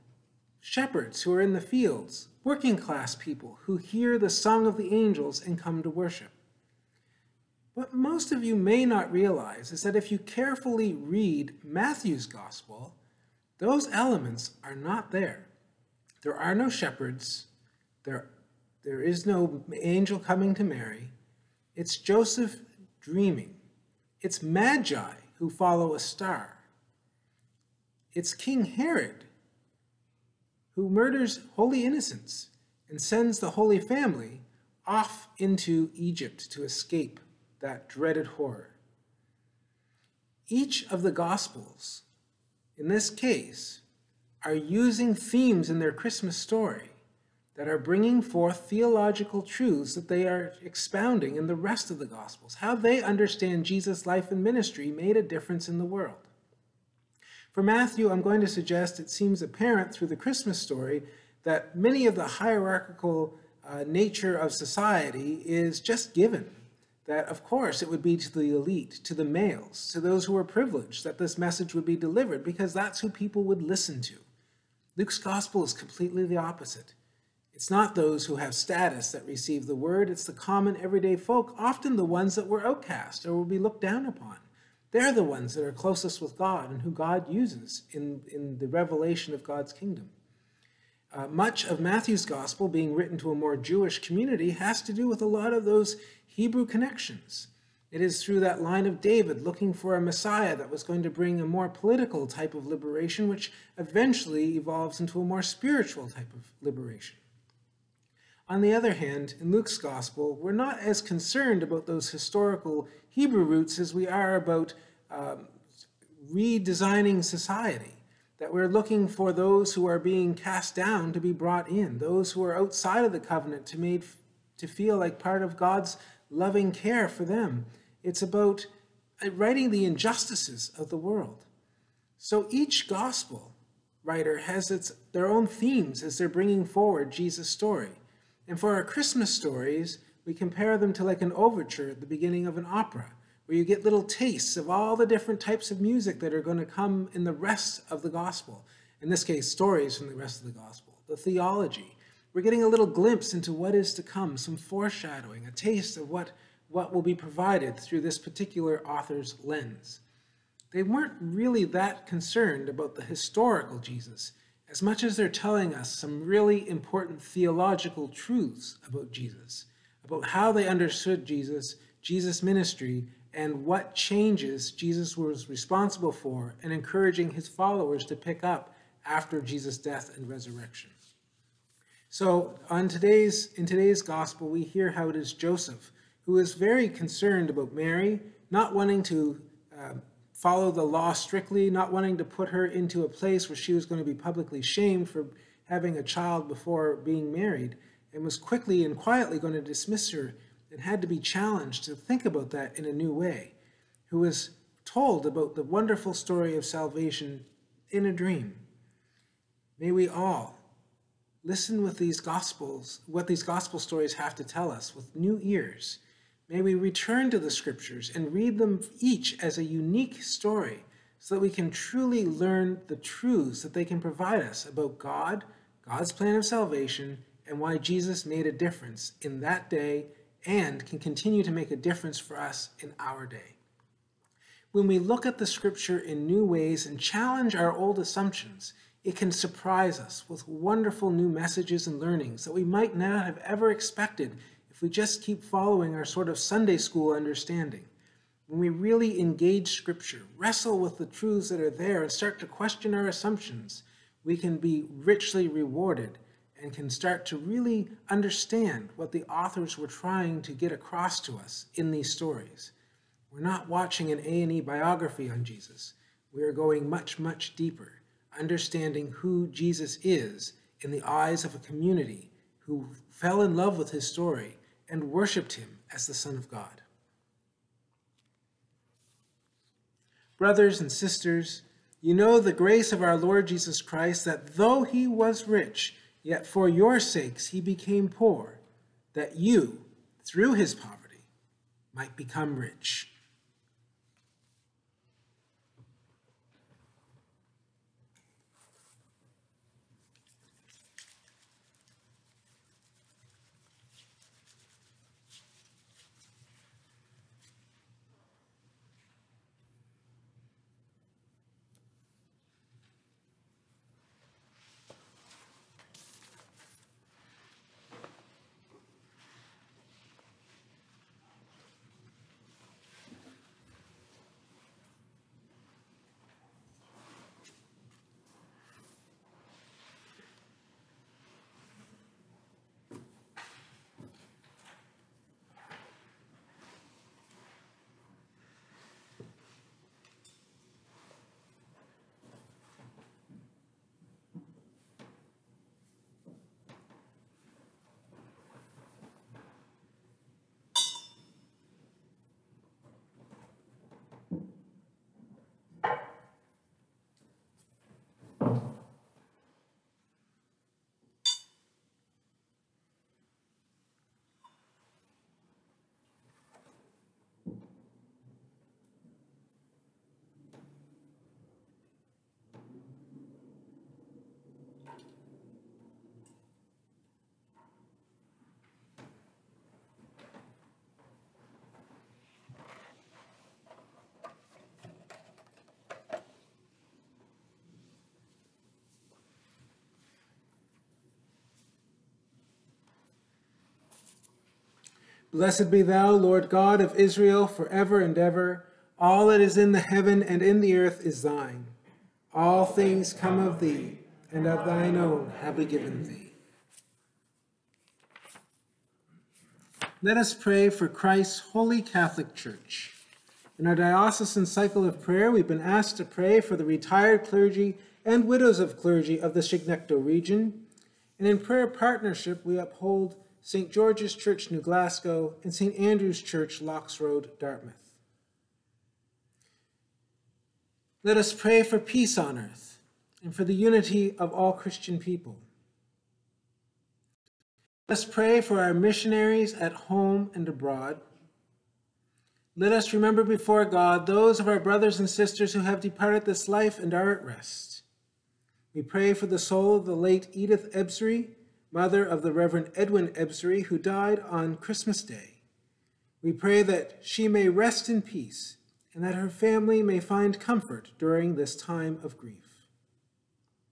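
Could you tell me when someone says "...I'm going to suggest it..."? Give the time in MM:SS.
00:58.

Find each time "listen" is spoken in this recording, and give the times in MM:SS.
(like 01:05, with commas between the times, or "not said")
01:13, 03:31.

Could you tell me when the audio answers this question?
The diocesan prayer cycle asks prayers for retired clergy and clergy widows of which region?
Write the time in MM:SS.
06:59.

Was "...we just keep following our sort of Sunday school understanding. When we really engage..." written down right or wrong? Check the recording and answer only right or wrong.
right.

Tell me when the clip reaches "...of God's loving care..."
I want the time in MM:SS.
02:05.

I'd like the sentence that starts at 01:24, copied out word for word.
They're the ones that are closest with God and who God uses in, in the revelation of God's kingdom.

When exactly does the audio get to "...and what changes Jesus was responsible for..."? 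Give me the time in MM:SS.
02:53.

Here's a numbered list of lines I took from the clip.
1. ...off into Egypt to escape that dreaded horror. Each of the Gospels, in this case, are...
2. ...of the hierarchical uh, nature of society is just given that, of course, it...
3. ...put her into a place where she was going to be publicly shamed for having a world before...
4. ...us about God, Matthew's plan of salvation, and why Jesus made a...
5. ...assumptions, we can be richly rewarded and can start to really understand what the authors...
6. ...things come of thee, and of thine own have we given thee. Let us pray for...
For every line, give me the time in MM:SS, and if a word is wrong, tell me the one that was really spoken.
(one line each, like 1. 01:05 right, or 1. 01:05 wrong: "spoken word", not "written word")
1. 00:34 right
2. 01:02 right
3. 03:12 wrong: "child", not "world"
4. 03:44 wrong: "God", not "Matthew"
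5. 04:13 right
6. 06:42 right.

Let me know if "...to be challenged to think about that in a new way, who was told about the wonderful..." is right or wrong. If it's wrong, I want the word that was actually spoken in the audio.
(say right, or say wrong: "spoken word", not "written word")
right.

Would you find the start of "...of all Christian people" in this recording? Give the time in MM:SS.
07:14.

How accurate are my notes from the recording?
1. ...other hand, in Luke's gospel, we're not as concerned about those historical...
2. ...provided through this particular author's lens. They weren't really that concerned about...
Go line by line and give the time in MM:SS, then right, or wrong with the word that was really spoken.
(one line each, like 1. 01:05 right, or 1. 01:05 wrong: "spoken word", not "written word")
1. 01:48 right
2. 02:37 right.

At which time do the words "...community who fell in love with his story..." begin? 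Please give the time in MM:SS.
04:31.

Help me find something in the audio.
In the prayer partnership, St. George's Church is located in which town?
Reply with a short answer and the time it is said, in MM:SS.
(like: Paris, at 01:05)
New Glasgow, at 07:04.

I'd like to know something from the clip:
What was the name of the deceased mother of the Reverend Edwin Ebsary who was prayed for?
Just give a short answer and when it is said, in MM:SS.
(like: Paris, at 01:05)
Edith Ebsary, at 07:30.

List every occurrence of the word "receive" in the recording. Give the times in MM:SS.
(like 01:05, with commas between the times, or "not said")
01:19.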